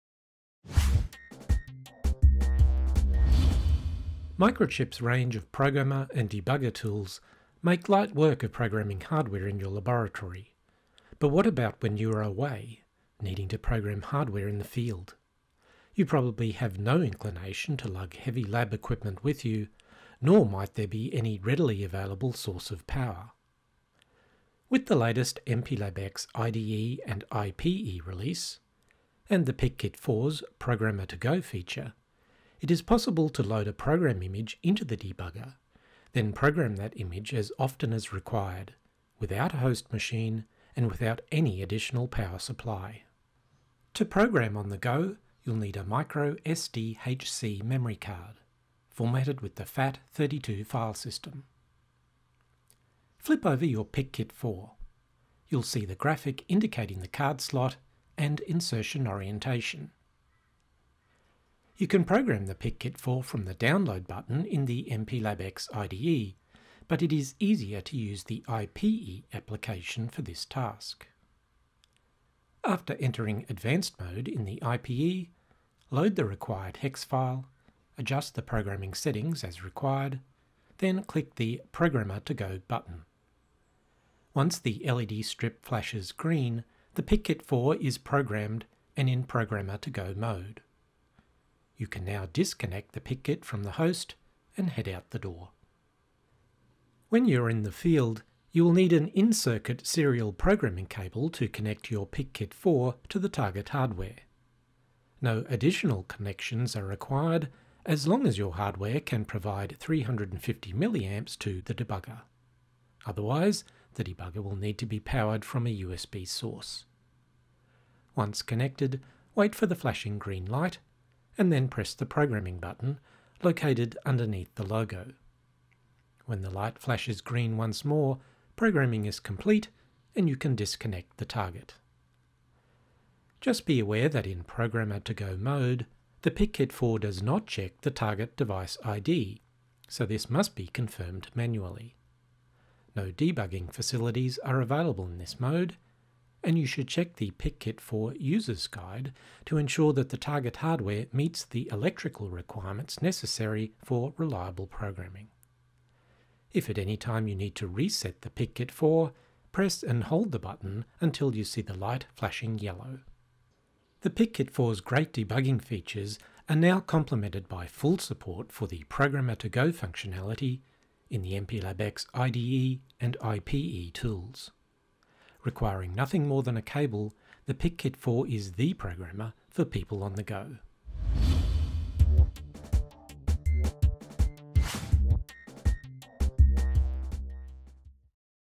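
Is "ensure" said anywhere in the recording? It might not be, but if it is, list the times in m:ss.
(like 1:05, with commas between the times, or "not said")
2:29.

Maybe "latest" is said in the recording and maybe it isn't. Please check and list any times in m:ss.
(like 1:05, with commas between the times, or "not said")
0:24.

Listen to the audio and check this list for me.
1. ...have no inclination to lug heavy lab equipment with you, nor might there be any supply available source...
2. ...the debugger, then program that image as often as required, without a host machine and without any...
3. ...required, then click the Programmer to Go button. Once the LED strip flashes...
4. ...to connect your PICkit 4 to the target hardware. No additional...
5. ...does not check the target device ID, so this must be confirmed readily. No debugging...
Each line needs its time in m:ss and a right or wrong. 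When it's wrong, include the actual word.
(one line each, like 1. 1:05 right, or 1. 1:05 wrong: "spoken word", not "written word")
1. 0:16 wrong: "readily", not "supply"
2. 0:34 right
3. 1:19 right
4. 1:41 right
5. 2:16 wrong: "manually", not "readily".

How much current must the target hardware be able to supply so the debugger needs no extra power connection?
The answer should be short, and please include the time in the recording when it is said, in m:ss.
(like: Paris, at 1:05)
350 milliamps, at 1:49.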